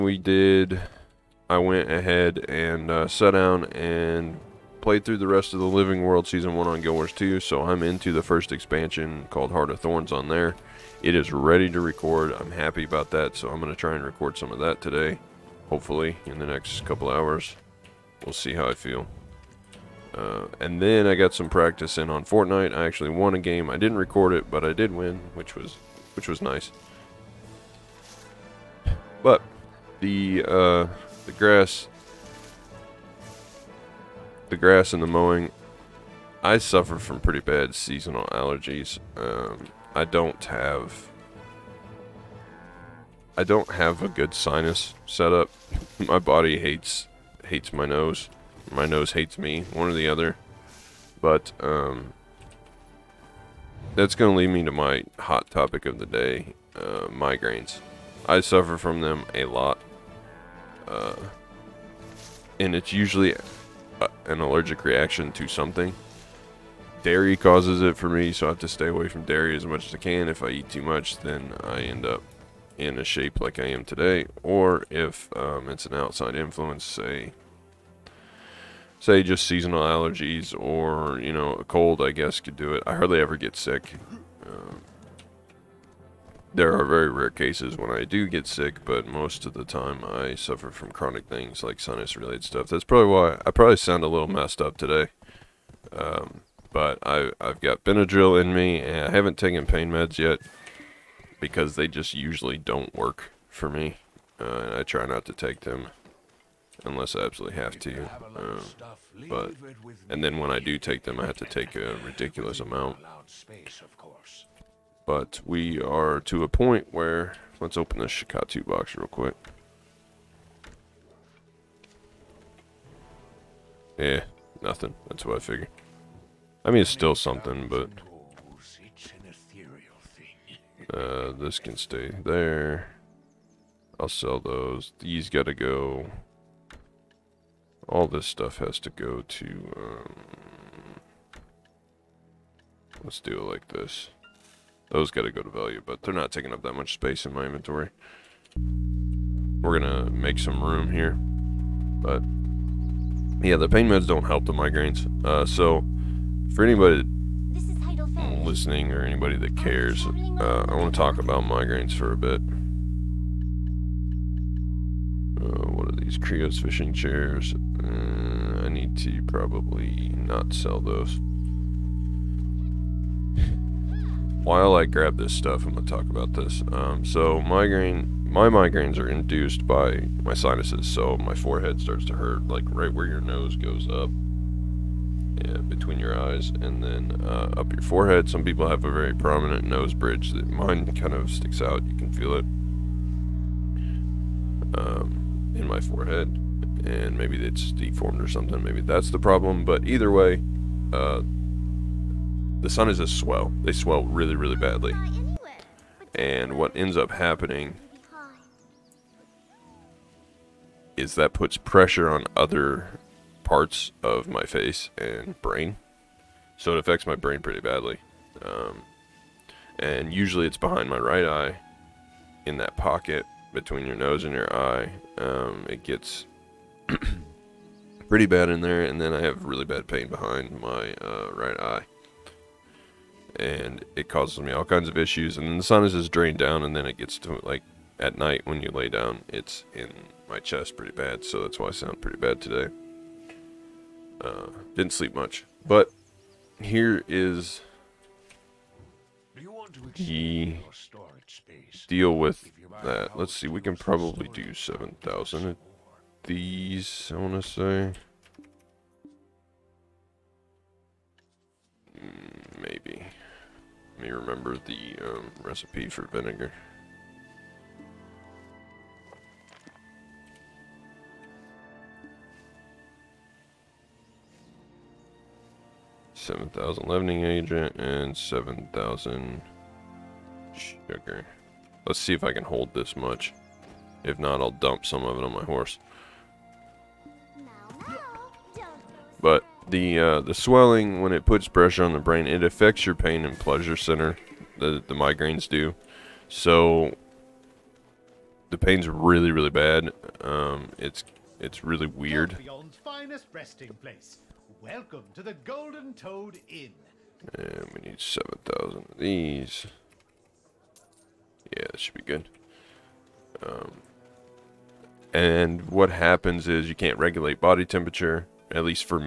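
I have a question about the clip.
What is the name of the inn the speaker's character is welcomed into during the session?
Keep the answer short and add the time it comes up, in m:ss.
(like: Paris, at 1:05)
Golden Toad Inn, at 5:05.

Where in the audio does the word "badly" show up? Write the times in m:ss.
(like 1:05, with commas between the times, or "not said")
3:24, 3:37.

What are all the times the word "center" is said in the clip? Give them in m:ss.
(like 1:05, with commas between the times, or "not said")
4:53.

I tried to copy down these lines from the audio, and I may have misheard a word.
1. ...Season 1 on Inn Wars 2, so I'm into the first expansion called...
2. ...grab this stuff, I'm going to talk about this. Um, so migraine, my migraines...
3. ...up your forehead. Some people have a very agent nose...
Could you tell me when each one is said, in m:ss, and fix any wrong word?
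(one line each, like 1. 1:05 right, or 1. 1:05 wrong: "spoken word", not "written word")
1. 0:06 wrong: "Guild", not "Inn"
2. 2:54 right
3. 3:07 wrong: "prominent", not "agent".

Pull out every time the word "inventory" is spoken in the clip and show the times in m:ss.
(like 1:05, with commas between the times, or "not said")
2:27.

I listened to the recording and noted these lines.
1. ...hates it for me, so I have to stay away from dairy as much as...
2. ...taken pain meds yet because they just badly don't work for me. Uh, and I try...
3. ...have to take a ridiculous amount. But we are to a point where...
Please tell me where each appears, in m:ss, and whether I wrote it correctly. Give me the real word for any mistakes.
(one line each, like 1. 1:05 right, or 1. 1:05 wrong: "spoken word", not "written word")
1. 1:07 wrong: "causes", not "hates"
2. 1:39 wrong: "usually", not "badly"
3. 1:51 right.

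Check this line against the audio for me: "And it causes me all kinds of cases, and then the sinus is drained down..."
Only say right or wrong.
wrong.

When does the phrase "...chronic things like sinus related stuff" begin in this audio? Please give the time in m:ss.
1:30.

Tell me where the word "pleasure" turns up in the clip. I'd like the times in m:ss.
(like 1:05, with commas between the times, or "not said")
4:53.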